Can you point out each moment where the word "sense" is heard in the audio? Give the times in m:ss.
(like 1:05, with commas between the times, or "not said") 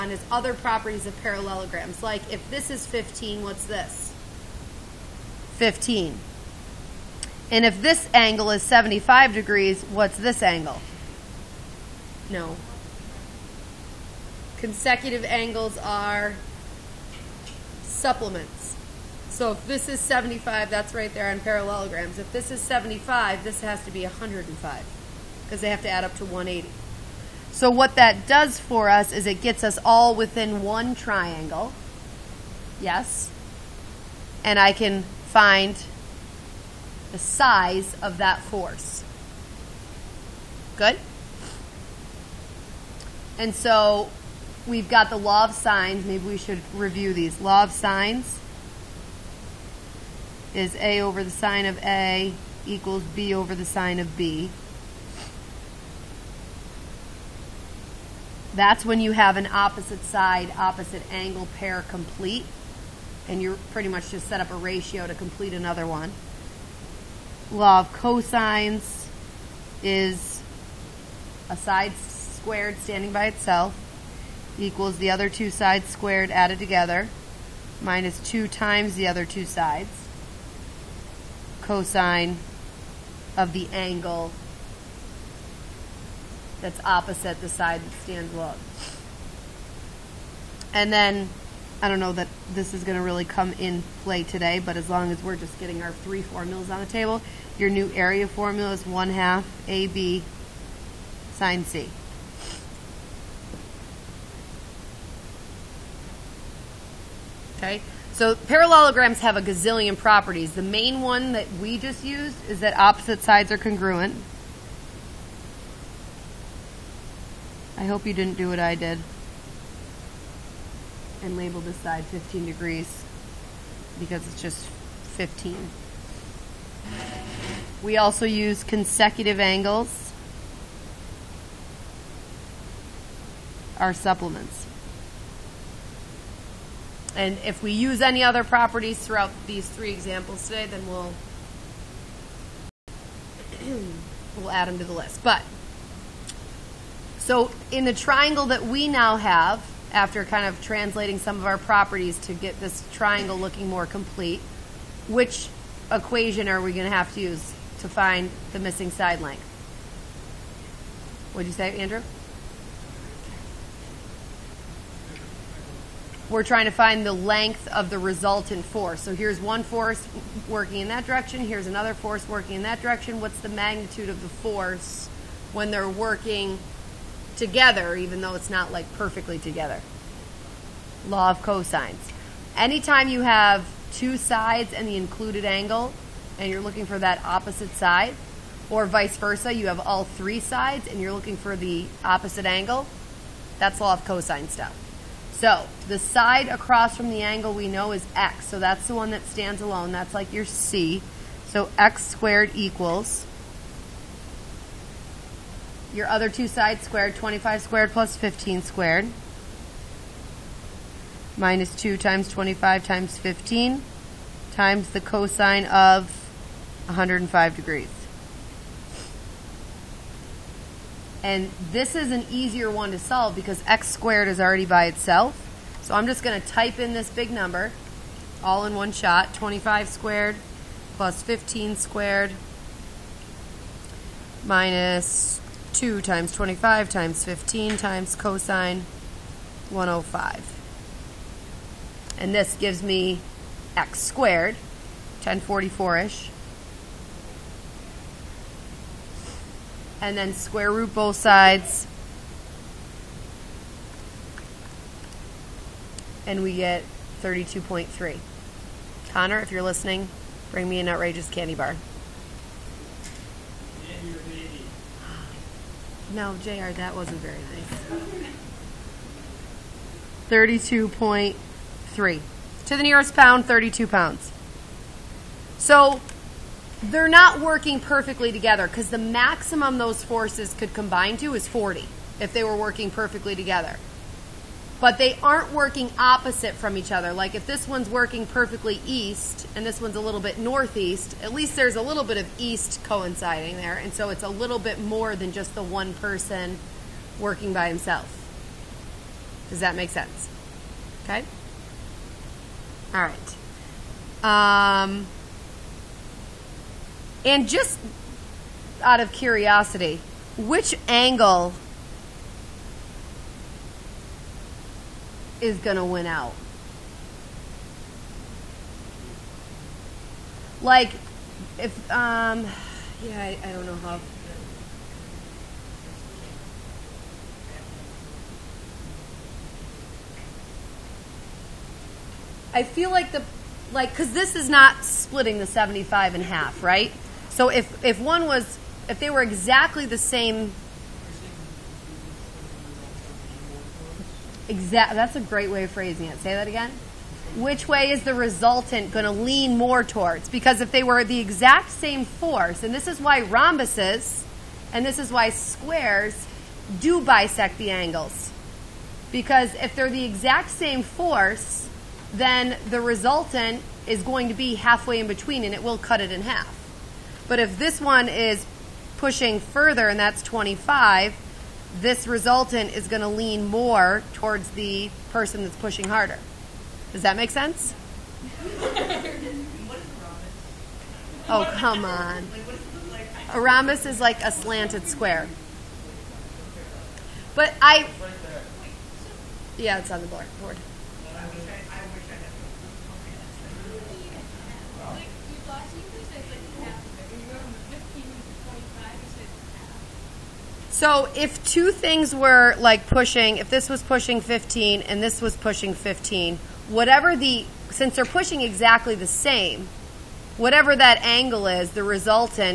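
4:59, 6:17.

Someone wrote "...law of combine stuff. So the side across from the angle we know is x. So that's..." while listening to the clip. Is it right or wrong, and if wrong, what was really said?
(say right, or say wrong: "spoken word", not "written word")
wrong: "cosine", not "combine".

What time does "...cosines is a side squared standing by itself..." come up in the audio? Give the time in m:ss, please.
1:07.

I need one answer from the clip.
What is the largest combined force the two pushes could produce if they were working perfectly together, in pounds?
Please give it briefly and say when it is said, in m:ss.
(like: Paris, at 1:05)
40, at 4:41.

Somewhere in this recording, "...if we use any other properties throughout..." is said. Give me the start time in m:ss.
2:17.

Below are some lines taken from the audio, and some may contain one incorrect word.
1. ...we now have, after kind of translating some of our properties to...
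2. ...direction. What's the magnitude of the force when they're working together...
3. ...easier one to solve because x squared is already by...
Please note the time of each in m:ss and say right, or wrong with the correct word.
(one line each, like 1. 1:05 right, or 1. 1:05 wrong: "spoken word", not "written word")
1. 2:28 right
2. 2:52 right
3. 3:42 right.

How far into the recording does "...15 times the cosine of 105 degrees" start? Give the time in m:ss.
3:33.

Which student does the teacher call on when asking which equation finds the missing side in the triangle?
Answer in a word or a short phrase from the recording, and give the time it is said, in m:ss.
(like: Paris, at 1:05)
Andrew, at 2:41.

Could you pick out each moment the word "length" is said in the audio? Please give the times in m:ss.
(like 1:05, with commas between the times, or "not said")
2:39, 2:47.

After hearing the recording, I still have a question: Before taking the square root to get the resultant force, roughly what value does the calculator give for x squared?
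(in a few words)
1044.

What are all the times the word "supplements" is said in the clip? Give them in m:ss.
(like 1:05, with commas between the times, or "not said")
0:17, 2:13.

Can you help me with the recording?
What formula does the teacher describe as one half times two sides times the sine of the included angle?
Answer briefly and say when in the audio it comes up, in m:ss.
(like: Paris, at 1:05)
area formula, at 1:37.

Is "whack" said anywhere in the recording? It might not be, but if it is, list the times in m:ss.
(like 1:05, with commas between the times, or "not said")
not said.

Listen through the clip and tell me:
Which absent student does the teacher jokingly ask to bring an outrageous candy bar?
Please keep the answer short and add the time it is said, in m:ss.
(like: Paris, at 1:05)
Connor, at 4:19.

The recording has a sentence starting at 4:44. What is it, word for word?
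But they aren't working opposite from each other.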